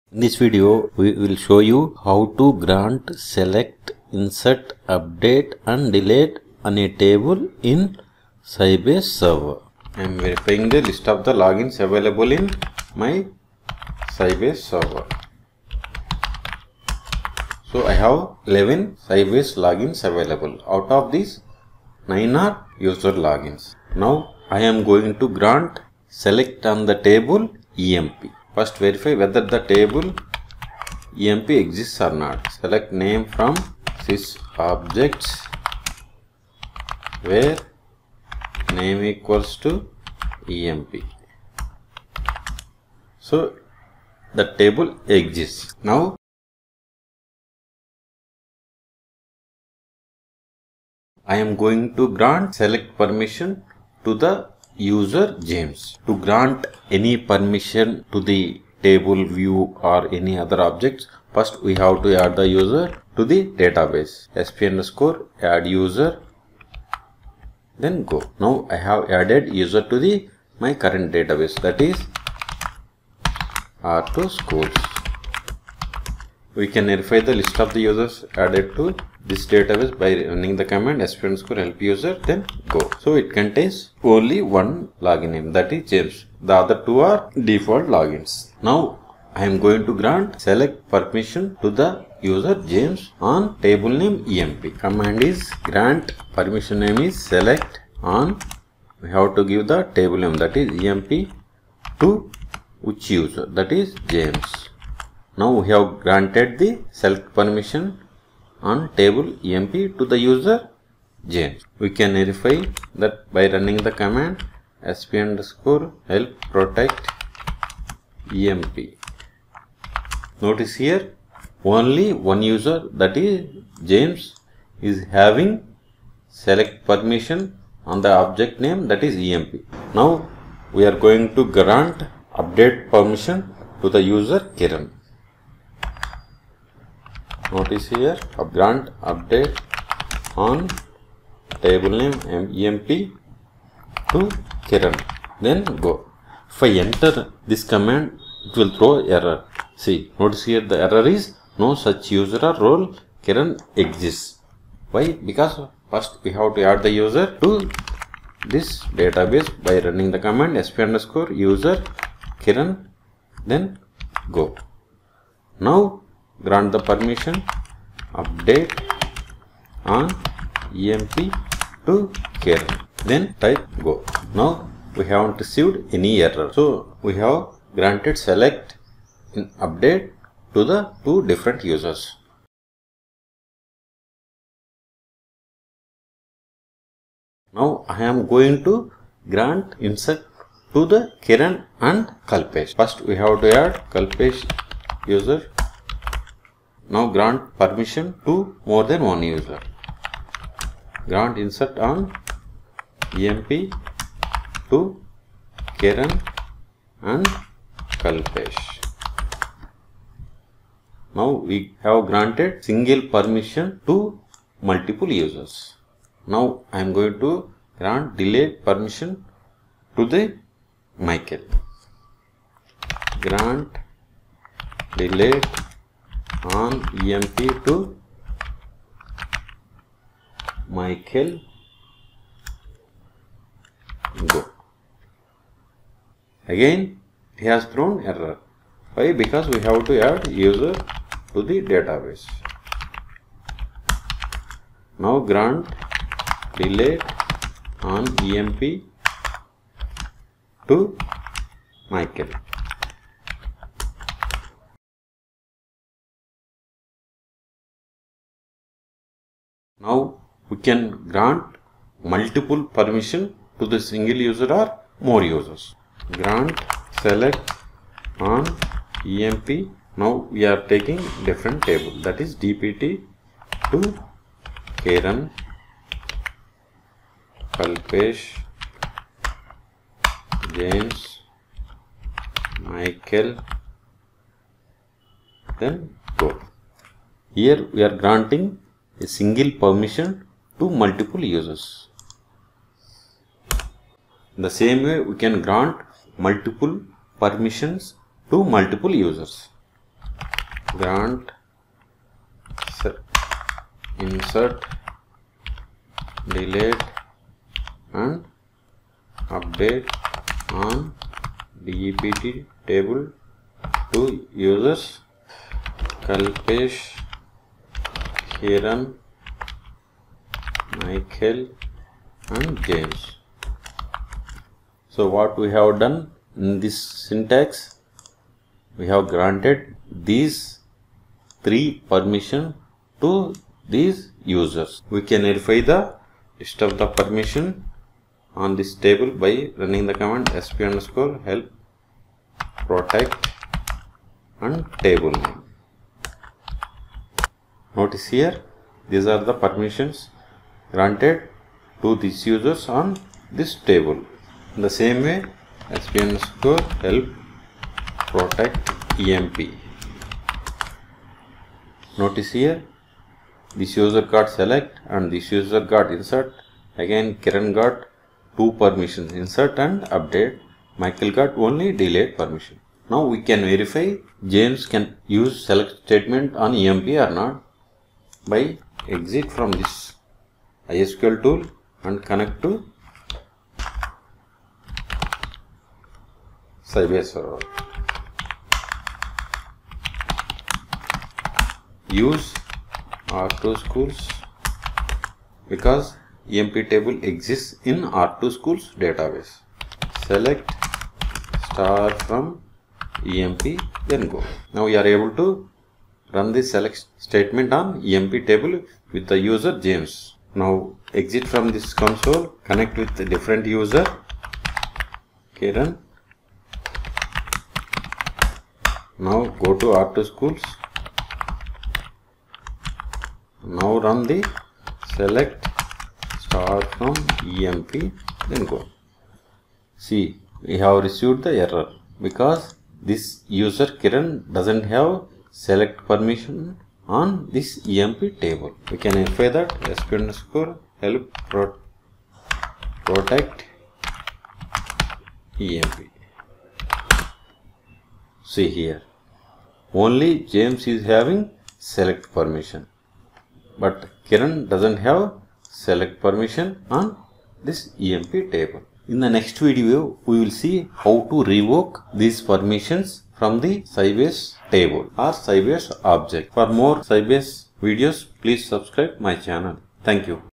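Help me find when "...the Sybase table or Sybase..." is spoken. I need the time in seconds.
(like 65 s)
463 s.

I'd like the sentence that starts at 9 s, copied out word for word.
I am verifying the list of the logins available in my Sybase server.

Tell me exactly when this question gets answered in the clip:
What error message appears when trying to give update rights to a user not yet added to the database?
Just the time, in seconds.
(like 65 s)
151 s.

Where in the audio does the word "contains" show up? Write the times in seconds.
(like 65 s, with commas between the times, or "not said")
83 s.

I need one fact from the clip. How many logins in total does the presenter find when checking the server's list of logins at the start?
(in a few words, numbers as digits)
11.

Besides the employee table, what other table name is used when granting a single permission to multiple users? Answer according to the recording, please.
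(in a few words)
DEPT.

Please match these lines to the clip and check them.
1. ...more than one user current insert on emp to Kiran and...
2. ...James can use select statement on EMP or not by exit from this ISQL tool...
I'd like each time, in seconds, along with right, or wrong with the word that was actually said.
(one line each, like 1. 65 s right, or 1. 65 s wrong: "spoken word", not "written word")
1. 198 s wrong: "grant", not "current"
2. 374 s right.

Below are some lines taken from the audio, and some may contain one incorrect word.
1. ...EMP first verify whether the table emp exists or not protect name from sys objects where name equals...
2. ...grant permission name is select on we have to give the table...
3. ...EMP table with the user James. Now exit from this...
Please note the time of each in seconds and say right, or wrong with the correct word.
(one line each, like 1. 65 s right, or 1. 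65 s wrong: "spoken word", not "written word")
1. 27 s wrong: "select", not "protect"
2. 95 s right
3. 407 s right.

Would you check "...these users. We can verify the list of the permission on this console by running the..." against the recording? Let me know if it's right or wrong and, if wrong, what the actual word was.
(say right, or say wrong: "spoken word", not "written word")
wrong: "table", not "console".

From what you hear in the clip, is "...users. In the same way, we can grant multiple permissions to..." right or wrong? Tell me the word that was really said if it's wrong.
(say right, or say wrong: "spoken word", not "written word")
right.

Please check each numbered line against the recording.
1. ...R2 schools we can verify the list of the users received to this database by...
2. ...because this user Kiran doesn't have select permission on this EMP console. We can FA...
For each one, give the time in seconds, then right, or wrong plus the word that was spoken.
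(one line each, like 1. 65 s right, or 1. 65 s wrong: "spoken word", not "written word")
1. 73 s wrong: "added", not "received"
2. 432 s wrong: "table", not "console".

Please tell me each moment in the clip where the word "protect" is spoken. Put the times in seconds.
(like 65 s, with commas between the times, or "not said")
116 s, 342 s, 358 s, 442 s.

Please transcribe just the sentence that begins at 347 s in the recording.
Notice here, these are the permissions granted to these users on this table.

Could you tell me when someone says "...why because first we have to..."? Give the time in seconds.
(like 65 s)
154 s.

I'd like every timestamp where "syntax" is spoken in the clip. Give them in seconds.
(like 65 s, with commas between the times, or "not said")
326 s.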